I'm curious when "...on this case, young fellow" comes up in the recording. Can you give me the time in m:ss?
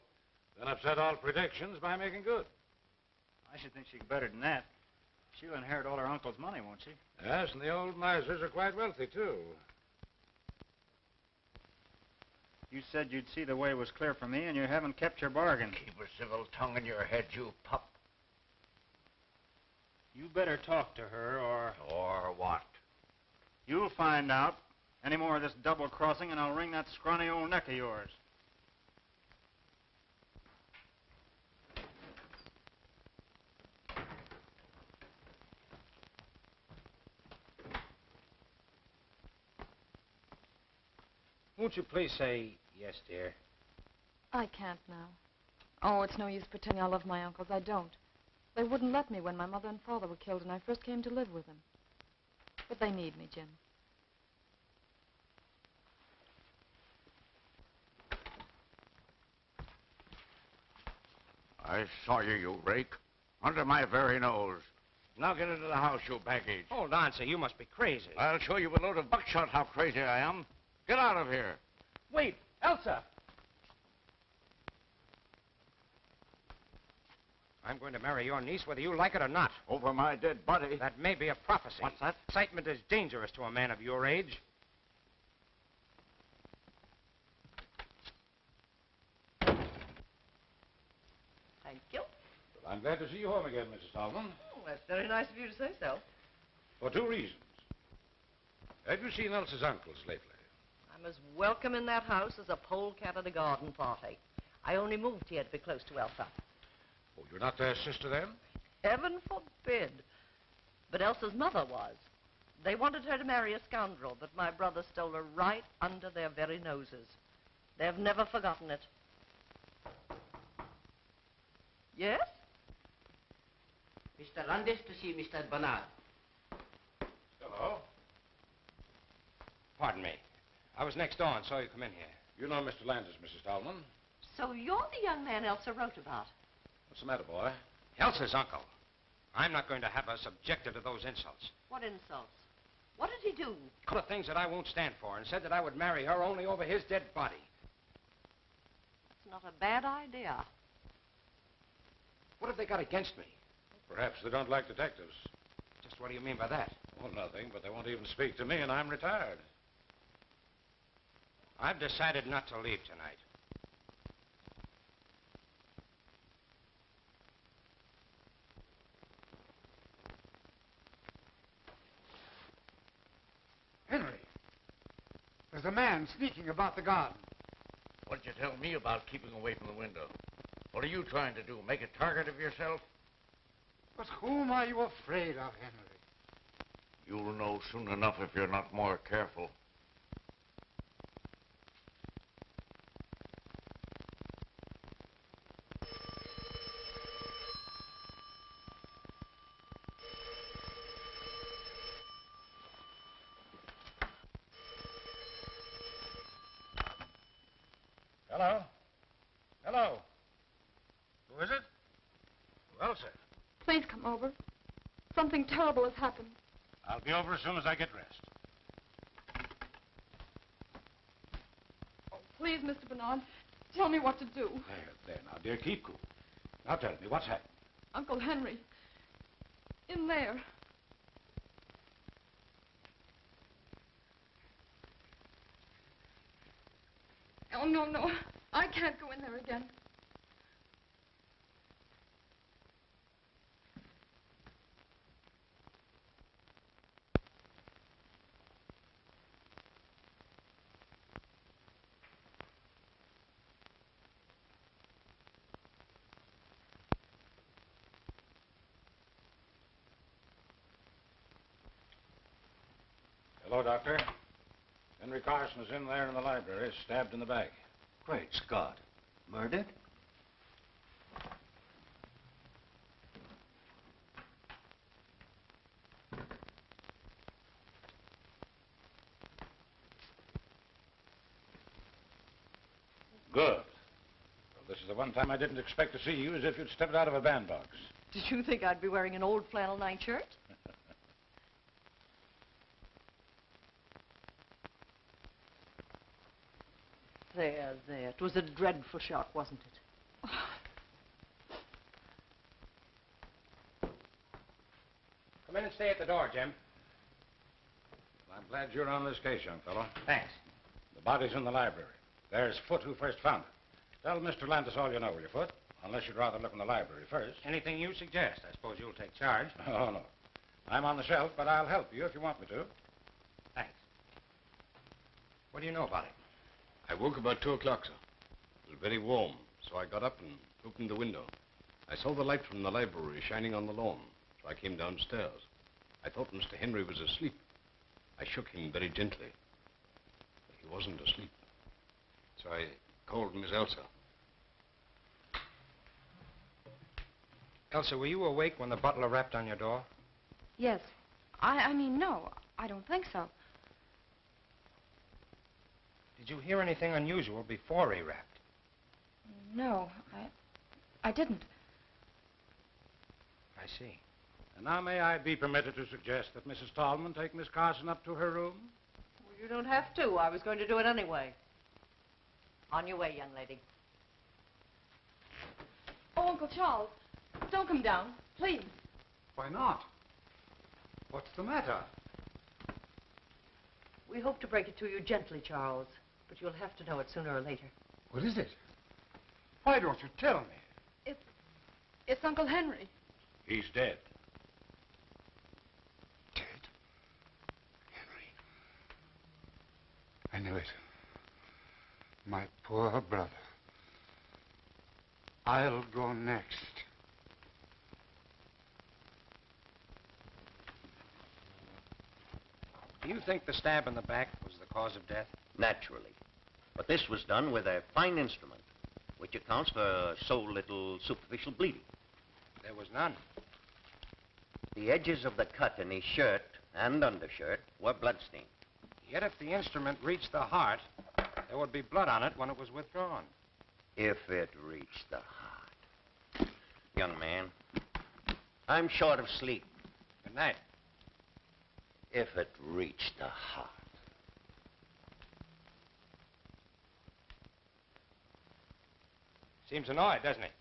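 5:08.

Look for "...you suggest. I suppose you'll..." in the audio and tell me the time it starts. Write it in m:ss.
5:17.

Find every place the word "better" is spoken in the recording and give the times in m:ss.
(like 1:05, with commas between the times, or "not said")
0:04, 0:20.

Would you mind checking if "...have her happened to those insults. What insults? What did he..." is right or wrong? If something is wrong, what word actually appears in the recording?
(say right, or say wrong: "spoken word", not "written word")
wrong: "subjected", not "happened".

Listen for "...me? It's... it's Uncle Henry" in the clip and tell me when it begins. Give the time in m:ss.
6:30.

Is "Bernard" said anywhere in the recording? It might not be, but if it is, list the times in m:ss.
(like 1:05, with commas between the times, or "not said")
2:05, 3:42.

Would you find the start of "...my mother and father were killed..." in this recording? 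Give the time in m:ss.
0:49.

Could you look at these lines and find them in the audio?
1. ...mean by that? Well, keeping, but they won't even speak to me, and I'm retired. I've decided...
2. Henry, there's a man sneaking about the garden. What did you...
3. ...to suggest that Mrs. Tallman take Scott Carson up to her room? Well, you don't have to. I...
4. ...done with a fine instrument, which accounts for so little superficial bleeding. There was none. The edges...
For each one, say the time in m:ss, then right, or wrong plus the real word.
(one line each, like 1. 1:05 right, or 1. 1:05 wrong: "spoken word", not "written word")
1. 2:36 wrong: "nothing", not "keeping"
2. 2:53 right
3. 6:05 wrong: "Miss", not "Scott"
4. 6:57 right.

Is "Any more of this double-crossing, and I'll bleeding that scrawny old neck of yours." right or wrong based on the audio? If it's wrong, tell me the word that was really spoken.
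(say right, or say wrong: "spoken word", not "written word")
wrong: "wring", not "bleeding".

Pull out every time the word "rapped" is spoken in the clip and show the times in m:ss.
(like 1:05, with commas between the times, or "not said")
5:49, 5:58.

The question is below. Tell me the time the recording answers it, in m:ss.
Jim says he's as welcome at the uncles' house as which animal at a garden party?
1:42.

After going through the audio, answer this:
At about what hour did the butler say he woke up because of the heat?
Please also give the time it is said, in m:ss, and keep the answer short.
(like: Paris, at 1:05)
2 o'clock, at 5:27.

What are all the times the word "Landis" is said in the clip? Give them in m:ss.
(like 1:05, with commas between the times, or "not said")
2:04, 2:12, 5:14.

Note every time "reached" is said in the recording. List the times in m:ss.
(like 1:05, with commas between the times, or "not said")
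7:10, 7:14, 7:22.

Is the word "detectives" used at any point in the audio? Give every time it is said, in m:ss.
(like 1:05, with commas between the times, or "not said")
2:34.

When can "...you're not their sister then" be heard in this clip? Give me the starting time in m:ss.
1:47.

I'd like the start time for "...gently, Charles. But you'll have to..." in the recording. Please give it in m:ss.
6:24.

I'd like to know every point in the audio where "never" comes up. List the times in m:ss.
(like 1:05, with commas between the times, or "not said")
1:57.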